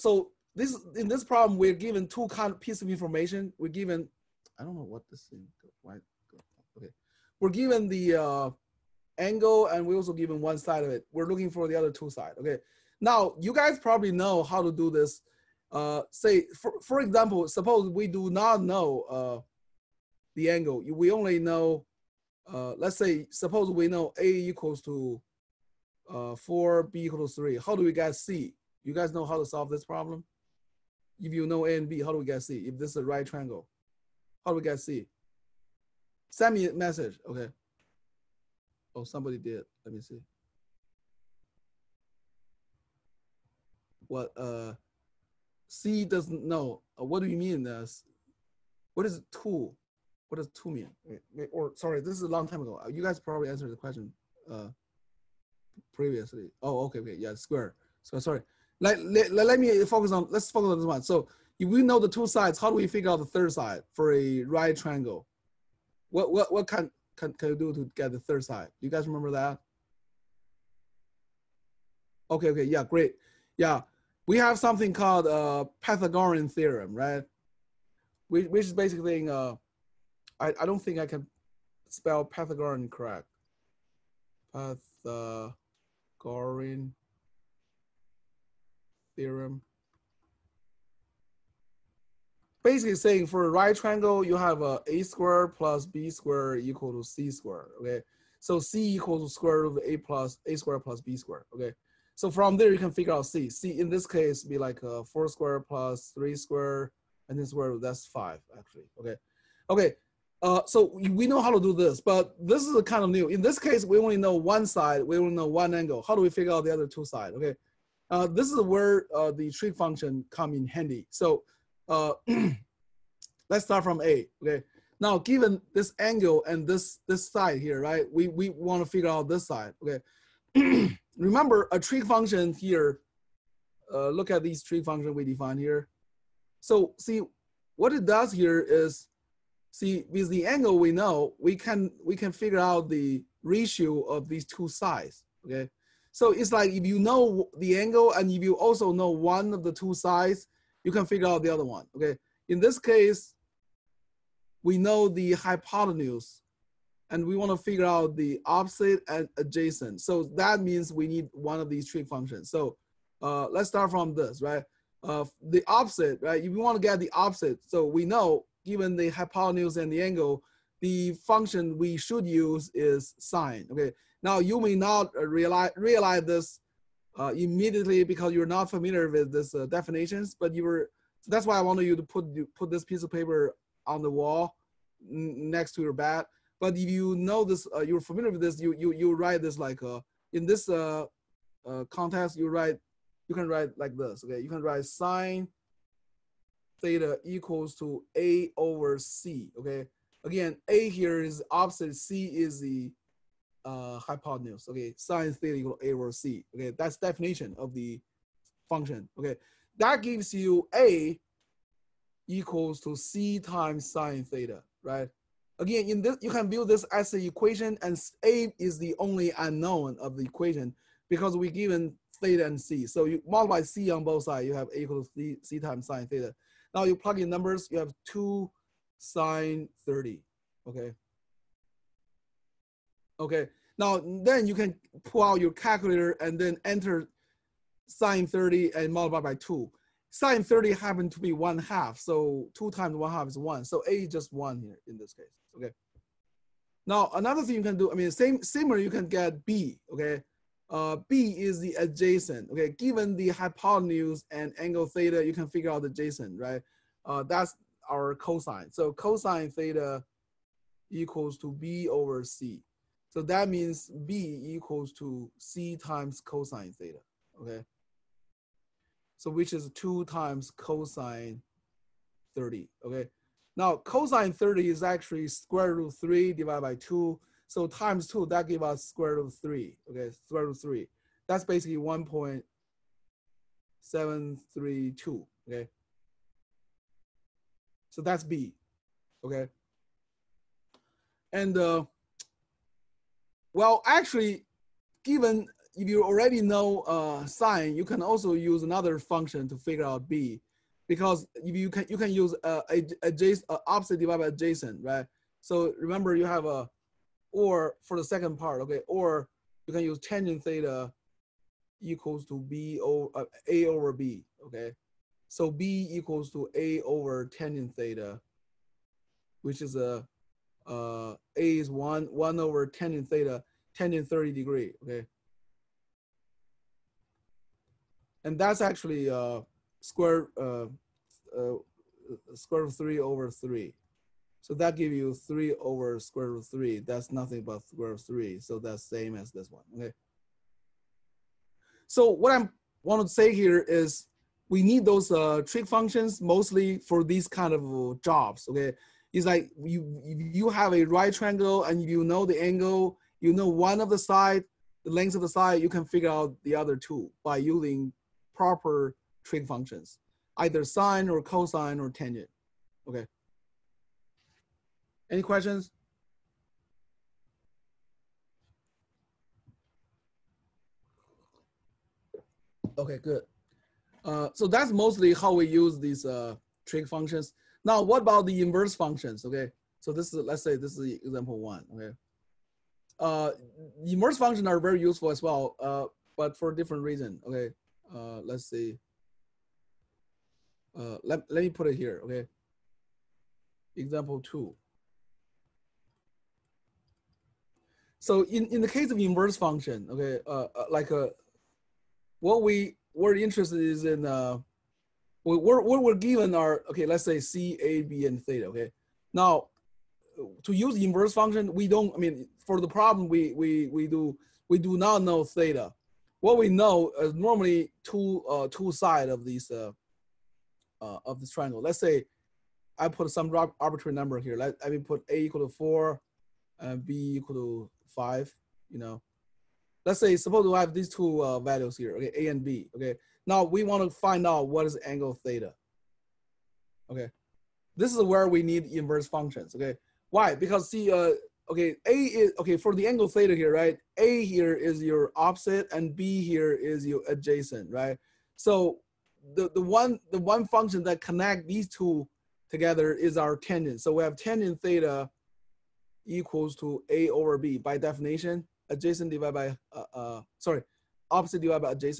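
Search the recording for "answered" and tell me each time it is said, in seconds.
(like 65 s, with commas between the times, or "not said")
53 s.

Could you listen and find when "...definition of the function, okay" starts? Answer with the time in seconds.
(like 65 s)
206 s.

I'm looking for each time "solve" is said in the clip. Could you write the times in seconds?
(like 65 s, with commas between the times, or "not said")
29 s.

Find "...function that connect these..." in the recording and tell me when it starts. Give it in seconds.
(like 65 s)
450 s.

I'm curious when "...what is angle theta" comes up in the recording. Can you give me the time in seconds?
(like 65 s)
434 s.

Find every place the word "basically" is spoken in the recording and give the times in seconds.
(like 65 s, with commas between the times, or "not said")
78 s, 92 s, 281 s.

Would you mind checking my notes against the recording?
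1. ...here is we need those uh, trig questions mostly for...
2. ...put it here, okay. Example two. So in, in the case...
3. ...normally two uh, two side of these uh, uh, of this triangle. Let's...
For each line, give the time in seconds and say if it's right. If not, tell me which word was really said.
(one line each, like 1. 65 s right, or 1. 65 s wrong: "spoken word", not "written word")
1. 343 s wrong: "functions", not "questions"
2. 391 s right
3. 417 s right.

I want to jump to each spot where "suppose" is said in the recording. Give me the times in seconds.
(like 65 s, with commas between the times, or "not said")
17 s, 23 s, 430 s.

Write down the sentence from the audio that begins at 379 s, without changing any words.
Okay, so this is, let's say this is example one, okay.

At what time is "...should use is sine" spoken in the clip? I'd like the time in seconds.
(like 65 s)
171 s.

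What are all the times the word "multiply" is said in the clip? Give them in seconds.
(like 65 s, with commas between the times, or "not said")
223 s, 238 s.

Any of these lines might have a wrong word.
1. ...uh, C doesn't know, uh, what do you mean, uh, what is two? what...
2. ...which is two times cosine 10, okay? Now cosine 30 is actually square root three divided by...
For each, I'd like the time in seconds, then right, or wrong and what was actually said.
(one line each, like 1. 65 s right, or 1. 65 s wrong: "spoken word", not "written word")
1. 44 s right
2. 269 s wrong: "30", not "10".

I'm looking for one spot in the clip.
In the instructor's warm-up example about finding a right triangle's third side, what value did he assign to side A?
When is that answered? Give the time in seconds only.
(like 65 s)
24 s.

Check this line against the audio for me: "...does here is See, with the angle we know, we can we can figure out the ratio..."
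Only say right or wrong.
right.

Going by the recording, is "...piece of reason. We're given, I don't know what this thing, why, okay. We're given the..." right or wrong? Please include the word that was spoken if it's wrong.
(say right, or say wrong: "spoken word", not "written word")
wrong: "information", not "reason".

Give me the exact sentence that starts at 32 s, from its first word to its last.
If this is a right triangle, how do we get C?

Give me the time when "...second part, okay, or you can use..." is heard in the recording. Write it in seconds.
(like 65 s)
308 s.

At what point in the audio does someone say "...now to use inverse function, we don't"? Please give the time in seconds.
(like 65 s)
409 s.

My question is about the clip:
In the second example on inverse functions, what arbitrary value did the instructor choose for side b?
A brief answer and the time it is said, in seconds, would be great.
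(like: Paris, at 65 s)
5, at 426 s.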